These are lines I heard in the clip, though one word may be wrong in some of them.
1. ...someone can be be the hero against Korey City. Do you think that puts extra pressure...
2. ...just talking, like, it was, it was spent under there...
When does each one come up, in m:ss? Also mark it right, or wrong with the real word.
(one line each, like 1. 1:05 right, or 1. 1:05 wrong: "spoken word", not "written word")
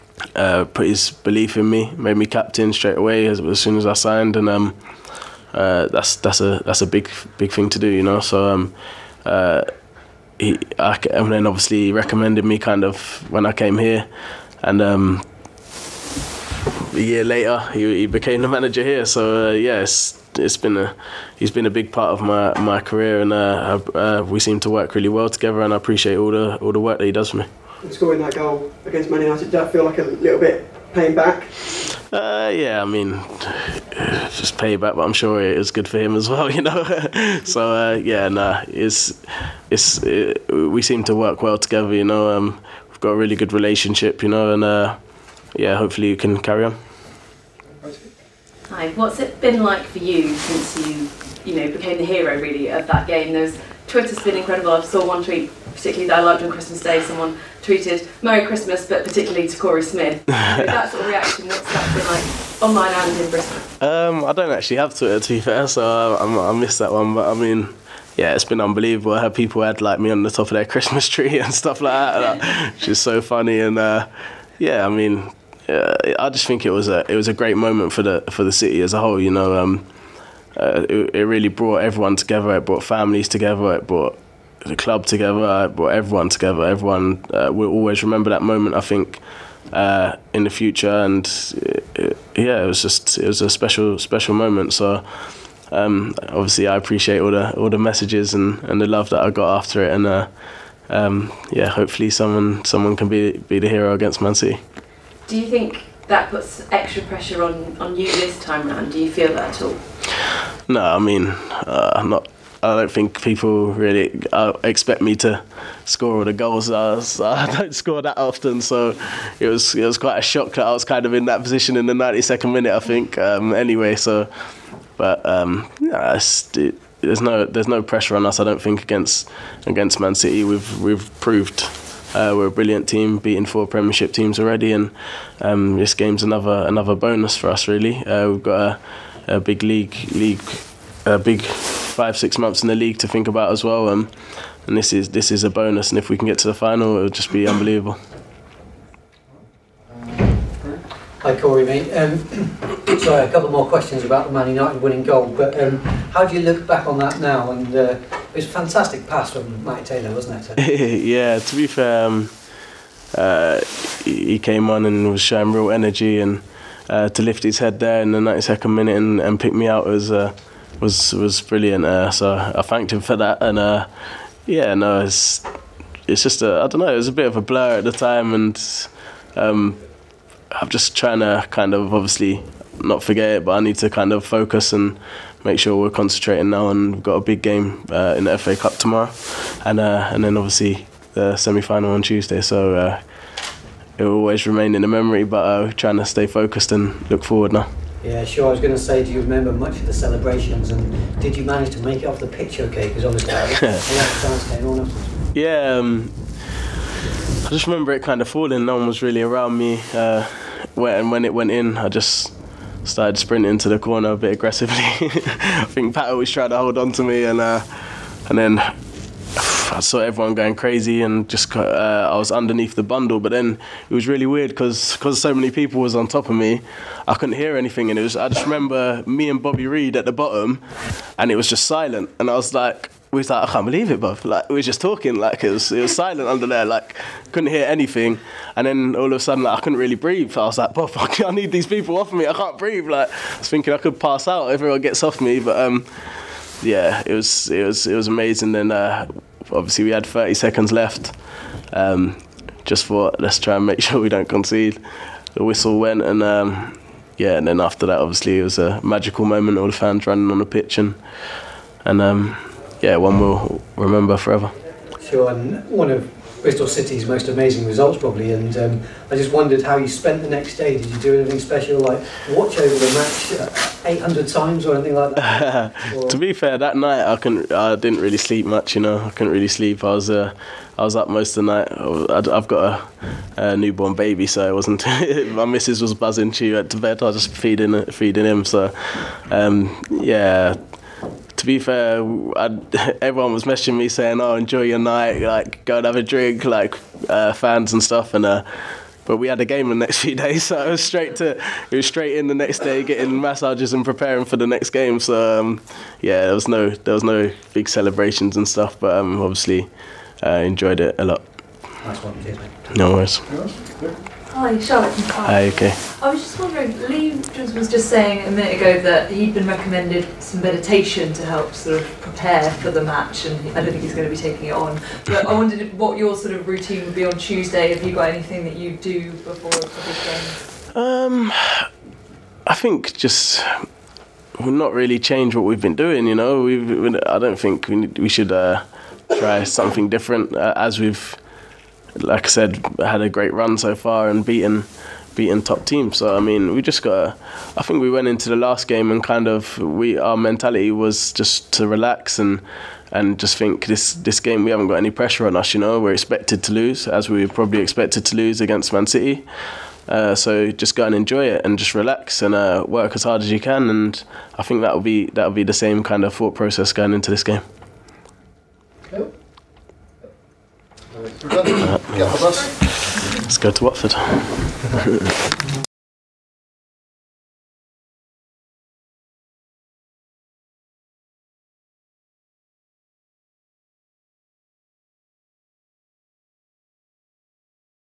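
1. 1:42 wrong: "Man", not "Korey"
2. 3:54 wrong: "silent", not "spent".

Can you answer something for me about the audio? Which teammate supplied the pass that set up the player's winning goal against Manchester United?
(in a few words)
Mike Taylor.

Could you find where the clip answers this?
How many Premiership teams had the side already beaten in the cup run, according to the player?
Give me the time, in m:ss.
2:13.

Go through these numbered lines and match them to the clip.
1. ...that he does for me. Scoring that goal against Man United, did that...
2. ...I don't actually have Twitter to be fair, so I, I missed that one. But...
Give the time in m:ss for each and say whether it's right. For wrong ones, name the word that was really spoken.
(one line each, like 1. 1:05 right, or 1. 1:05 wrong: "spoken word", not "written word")
1. 0:26 right
2. 1:04 right.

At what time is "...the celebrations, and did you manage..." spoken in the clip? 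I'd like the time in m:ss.
3:19.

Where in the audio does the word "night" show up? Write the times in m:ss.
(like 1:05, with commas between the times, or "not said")
4:36, 4:41, 4:54.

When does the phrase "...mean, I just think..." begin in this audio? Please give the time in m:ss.
1:14.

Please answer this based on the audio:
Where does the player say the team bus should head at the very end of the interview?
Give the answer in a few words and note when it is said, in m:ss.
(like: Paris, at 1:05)
Watford, at 6:13.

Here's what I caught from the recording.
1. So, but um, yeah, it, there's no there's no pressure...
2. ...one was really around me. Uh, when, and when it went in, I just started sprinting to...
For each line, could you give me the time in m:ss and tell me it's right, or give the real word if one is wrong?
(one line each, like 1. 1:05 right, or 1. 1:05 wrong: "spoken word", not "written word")
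1. 2:03 right
2. 3:28 right.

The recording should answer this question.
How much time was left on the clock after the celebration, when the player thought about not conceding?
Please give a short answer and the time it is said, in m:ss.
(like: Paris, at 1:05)
30 seconds, at 4:10.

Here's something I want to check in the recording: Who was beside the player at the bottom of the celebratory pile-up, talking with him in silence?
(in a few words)
Bobby Reid.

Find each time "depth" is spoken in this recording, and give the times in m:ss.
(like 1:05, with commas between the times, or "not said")
not said.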